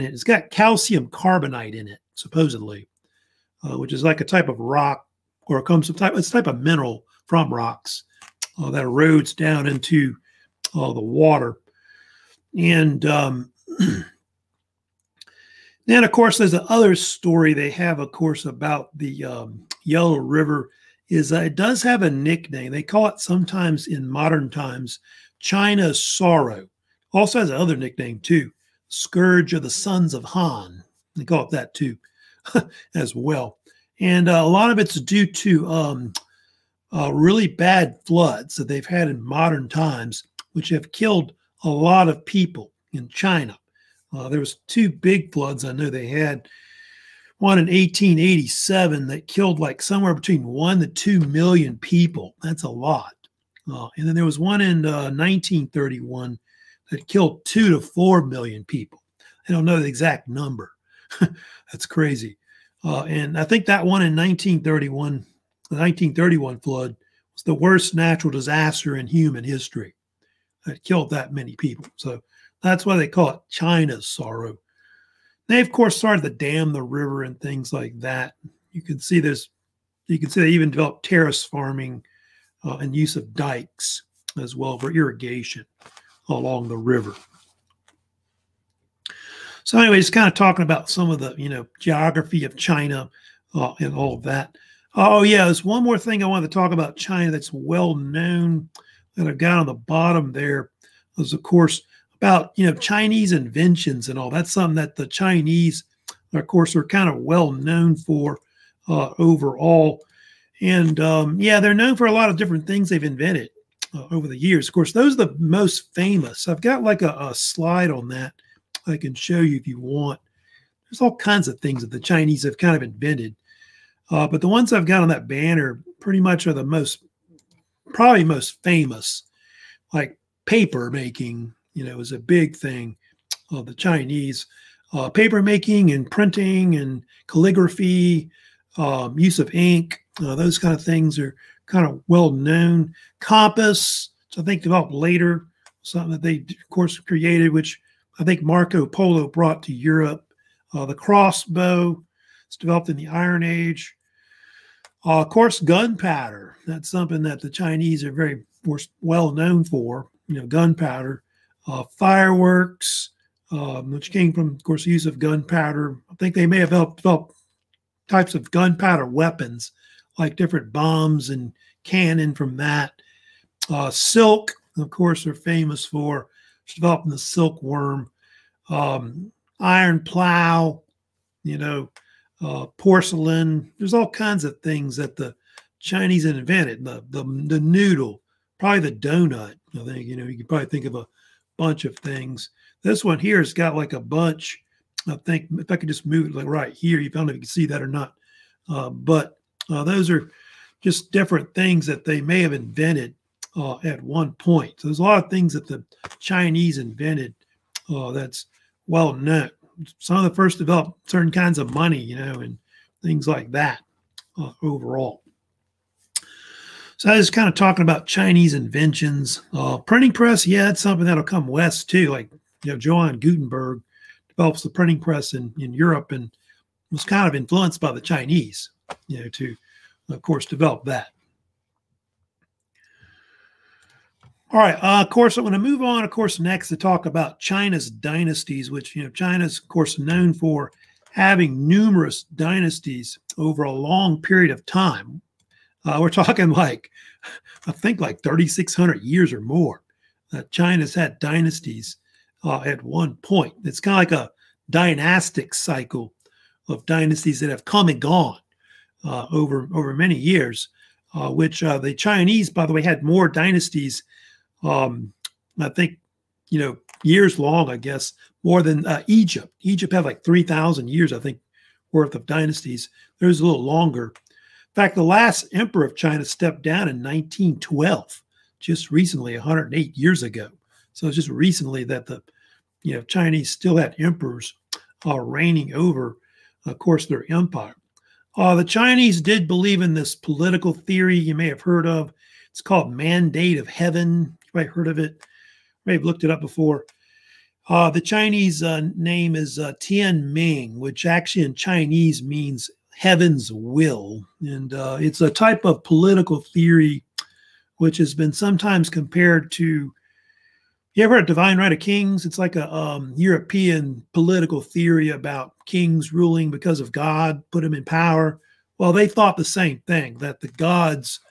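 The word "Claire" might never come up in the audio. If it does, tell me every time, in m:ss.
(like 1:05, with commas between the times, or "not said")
not said.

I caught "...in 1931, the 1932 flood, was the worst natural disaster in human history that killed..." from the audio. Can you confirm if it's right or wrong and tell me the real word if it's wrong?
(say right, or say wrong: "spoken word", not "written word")
wrong: "1931", not "1932".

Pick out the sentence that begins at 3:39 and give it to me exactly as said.
Uh, printing press, yeah, it's something that'll come west too.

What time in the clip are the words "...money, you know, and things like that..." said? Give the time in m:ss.
3:31.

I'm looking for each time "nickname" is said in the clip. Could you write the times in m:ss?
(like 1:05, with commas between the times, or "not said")
0:22, 0:27.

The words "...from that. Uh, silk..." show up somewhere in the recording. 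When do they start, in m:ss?
2:52.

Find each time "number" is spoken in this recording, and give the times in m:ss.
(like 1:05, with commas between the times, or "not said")
1:00.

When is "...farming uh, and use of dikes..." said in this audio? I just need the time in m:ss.
1:21.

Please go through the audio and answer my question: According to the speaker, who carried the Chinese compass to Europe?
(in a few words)
Marco Polo.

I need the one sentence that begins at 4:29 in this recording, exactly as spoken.
Egypt had like 3,000 years, I think, worth of dynasties.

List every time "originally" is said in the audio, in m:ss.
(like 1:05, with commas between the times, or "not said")
not said.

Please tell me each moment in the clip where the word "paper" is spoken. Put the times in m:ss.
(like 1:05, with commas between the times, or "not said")
2:10, 2:15.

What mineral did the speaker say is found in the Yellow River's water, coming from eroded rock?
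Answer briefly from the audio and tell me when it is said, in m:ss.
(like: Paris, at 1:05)
calcium carbonate, at 0:00.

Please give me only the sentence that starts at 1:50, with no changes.
And um, yeah, they're known for a lot of different things they've invented uh, over the years.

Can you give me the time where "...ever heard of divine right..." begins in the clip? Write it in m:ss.
5:11.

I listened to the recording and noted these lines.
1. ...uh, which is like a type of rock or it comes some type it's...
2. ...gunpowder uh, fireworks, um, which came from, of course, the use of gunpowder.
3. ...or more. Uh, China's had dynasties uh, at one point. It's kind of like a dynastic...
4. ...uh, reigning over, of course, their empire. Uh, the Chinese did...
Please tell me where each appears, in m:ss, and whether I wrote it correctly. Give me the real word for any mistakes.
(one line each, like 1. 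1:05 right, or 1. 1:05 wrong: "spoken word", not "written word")
1. 0:03 right
2. 2:40 right
3. 4:09 right
4. 4:45 right.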